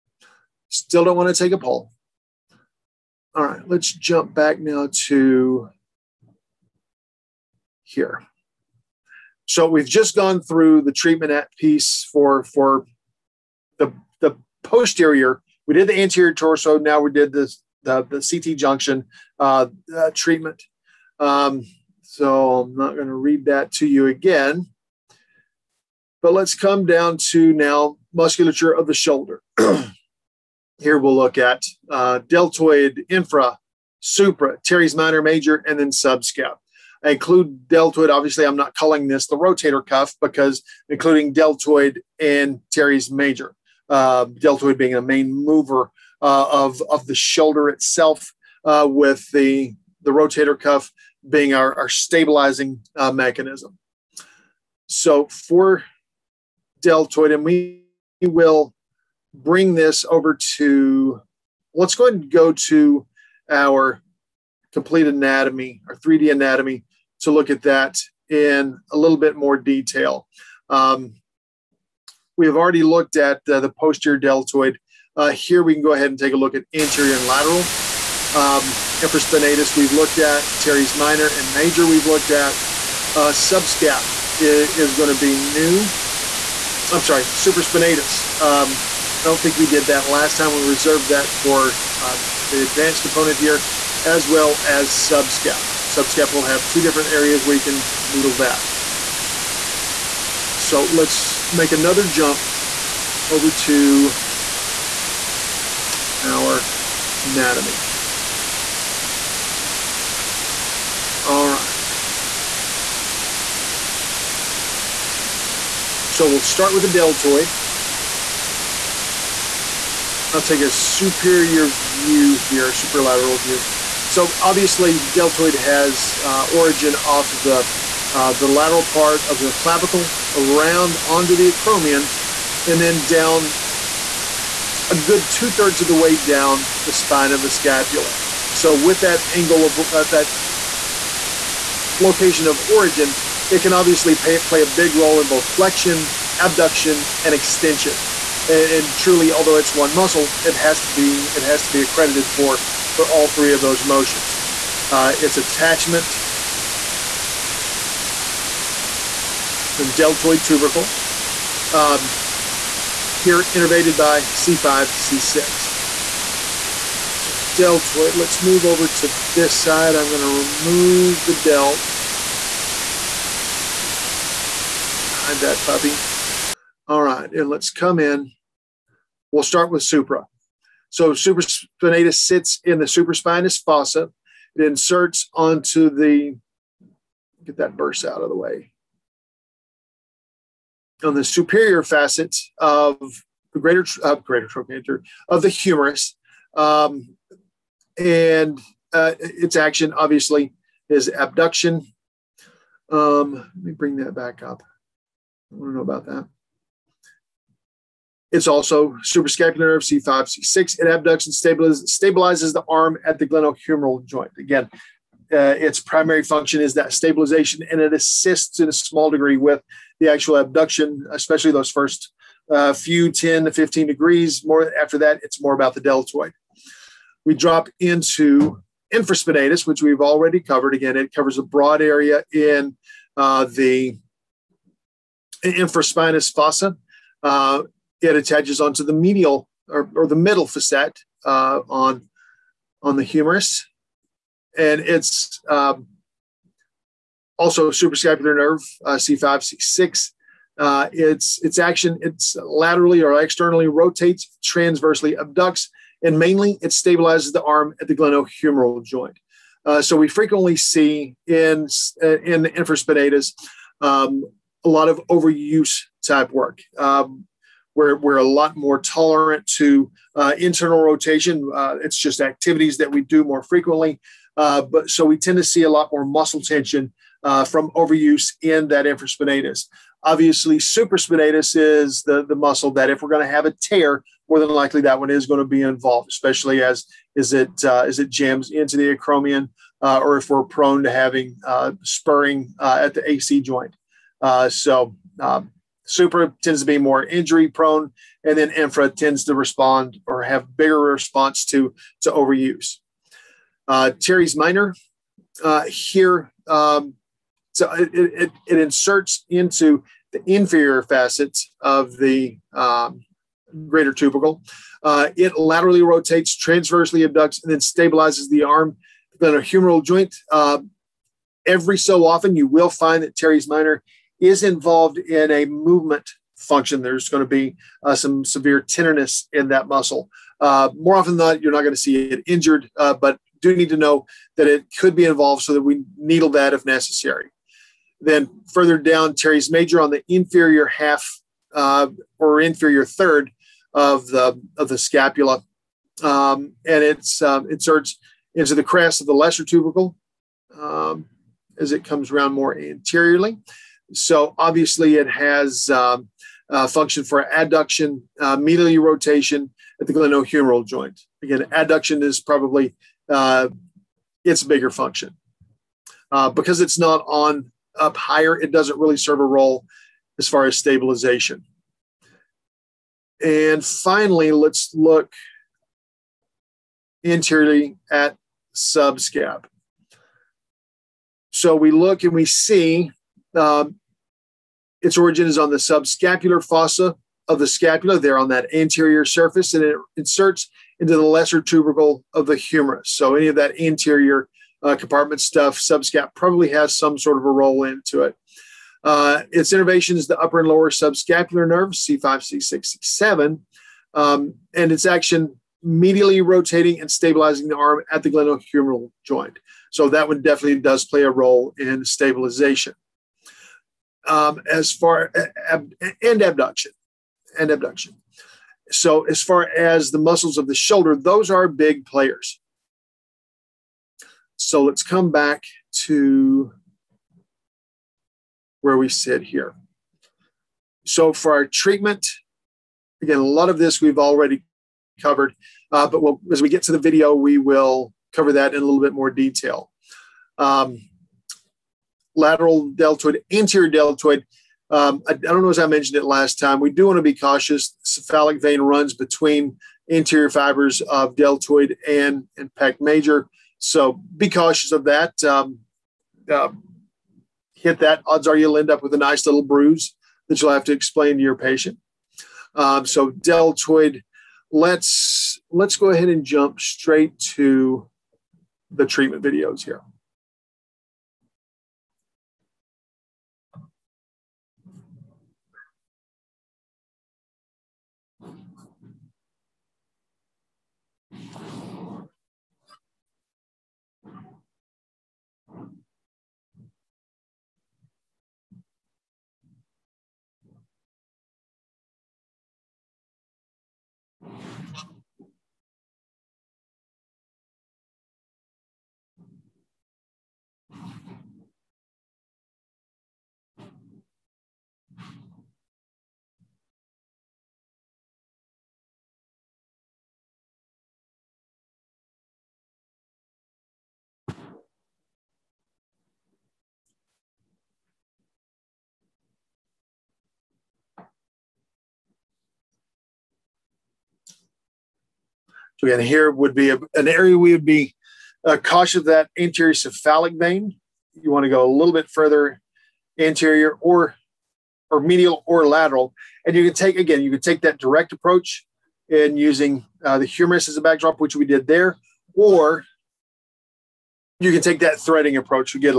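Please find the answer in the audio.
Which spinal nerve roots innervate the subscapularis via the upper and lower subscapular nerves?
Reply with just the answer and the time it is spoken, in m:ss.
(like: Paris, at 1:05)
C5, C6, C7, at 6:41.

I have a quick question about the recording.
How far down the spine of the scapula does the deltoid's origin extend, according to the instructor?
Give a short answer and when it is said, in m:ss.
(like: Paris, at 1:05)
two thirds, at 2:15.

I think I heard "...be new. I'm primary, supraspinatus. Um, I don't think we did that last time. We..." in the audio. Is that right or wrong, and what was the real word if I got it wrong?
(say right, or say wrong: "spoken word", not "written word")
wrong: "sorry", not "primary".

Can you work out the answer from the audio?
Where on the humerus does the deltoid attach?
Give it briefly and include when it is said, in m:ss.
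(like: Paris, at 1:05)
deltoid tubercle, at 2:39.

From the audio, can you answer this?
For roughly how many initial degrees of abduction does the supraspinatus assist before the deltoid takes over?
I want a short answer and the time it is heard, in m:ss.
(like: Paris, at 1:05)
10 to 15, at 3:43.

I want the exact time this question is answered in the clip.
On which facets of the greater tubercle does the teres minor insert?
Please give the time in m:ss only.
5:10.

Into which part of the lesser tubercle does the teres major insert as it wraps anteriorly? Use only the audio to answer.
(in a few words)
the crest.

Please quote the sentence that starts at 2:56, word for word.
All right, and let's come in.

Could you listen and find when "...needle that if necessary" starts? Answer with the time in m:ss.
5:35.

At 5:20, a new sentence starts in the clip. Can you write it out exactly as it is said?
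Uh, every so often, you will find that Teres minor is involved in a movement function.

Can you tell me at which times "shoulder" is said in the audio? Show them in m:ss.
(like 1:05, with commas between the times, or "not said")
0:28, 0:47, 7:00.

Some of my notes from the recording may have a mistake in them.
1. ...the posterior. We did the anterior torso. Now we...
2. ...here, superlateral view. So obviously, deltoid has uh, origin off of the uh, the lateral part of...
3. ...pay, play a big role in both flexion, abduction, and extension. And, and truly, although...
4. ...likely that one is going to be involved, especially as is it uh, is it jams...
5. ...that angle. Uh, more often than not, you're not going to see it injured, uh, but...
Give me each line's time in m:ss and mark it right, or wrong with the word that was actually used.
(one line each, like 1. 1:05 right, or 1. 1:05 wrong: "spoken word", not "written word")
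1. 0:14 right
2. 2:02 right
3. 2:24 right
4. 4:44 right
5. 5:29 wrong: "muscle", not "angle".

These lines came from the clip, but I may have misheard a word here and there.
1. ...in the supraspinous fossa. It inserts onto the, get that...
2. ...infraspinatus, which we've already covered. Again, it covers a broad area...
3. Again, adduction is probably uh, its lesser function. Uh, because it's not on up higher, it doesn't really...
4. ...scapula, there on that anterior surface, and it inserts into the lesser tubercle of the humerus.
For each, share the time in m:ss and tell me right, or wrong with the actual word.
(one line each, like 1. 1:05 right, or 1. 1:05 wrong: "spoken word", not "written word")
1. 3:02 right
2. 3:48 right
3. 6:01 wrong: "bigger", not "lesser"
4. 6:27 right.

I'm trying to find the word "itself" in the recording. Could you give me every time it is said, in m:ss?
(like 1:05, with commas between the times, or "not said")
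0:47.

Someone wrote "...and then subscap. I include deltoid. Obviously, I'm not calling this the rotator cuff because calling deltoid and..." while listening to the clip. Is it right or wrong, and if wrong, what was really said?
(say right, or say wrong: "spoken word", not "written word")
wrong: "including", not "calling".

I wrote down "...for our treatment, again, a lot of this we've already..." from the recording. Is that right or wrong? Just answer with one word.
right.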